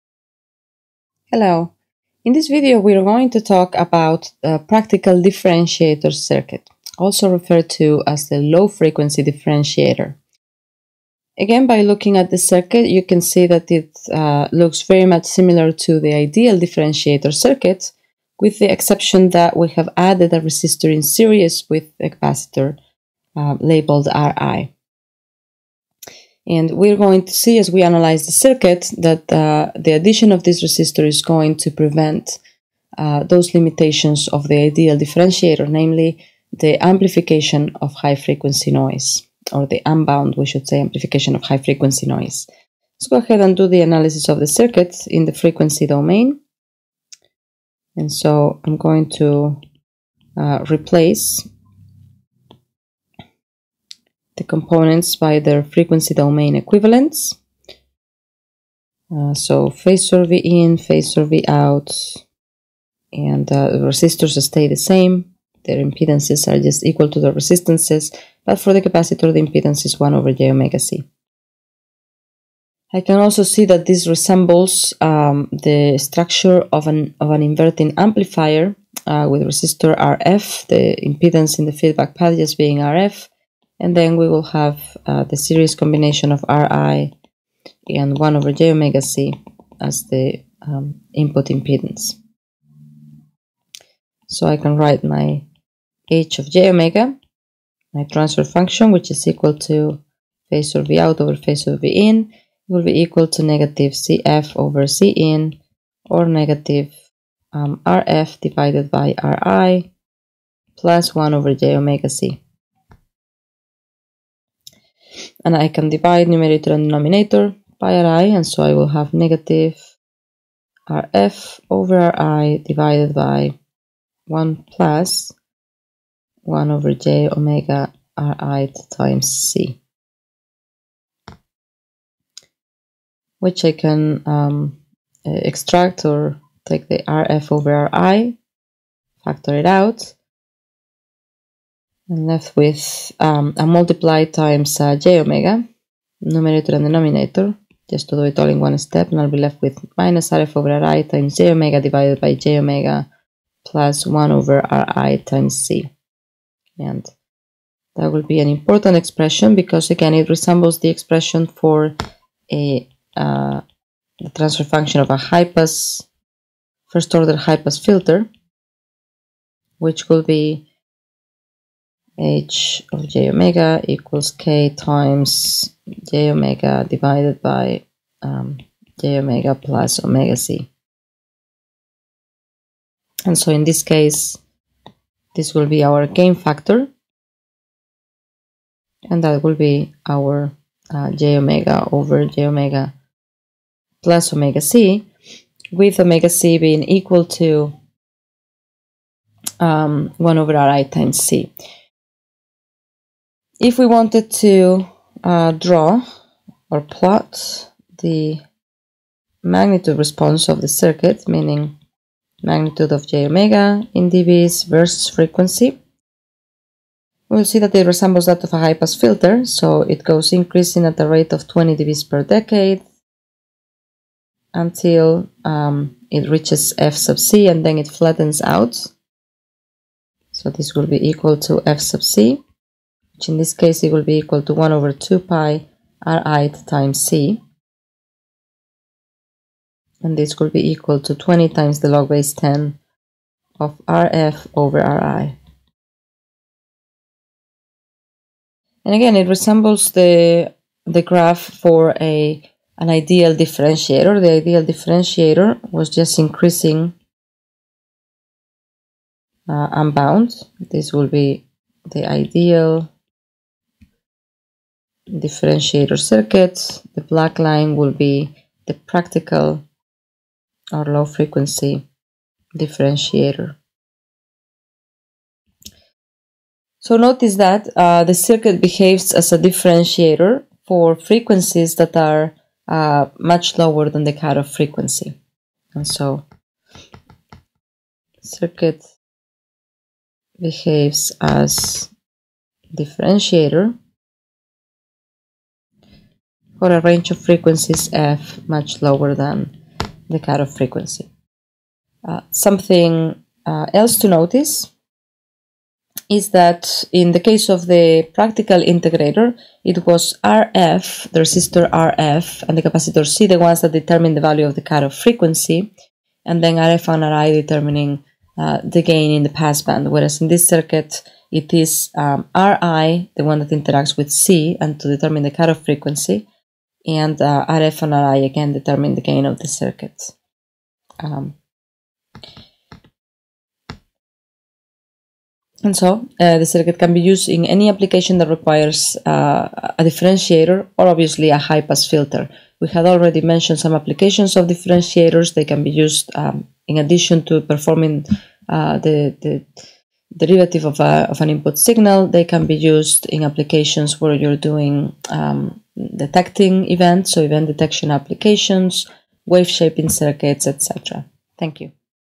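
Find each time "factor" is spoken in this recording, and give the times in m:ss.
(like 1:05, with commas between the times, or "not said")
2:19, 3:06.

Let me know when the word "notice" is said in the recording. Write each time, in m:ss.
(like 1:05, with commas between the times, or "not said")
4:36, 5:04.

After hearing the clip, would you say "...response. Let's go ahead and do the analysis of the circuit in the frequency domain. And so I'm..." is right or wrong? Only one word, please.
wrong.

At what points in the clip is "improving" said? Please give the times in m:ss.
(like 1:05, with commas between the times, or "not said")
not said.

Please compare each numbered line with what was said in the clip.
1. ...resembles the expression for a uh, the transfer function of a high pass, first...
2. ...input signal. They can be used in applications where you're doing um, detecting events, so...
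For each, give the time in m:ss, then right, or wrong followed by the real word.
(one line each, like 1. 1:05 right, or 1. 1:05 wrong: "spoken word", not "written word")
1. 2:40 right
2. 5:51 right.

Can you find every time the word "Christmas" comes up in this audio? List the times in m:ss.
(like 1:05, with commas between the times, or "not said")
not said.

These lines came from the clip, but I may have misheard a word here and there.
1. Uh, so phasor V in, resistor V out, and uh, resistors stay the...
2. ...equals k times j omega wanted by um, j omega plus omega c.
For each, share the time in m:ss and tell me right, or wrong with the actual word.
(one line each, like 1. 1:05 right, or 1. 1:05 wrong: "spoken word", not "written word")
1. 0:59 wrong: "phasor", not "resistor"
2. 2:53 wrong: "divided", not "wanted".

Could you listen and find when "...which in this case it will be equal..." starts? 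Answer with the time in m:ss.
3:53.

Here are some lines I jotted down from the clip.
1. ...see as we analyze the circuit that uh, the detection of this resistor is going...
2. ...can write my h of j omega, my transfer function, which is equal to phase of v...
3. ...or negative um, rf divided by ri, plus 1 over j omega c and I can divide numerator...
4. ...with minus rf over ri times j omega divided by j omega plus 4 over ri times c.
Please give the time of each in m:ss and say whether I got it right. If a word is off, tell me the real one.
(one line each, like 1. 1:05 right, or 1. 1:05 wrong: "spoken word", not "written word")
1. 0:27 wrong: "addition", not "detection"
2. 1:34 right
3. 1:46 right
4. 2:29 wrong: "1", not "4".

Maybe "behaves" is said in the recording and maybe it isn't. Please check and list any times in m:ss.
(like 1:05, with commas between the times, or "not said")
4:38, 4:50.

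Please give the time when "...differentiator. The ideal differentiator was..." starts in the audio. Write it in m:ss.
4:13.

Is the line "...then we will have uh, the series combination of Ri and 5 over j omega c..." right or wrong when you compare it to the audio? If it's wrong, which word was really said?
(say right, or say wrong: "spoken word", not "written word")
wrong: "1", not "5".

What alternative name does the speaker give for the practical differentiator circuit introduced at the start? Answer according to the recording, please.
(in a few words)
low-frequency differentiator.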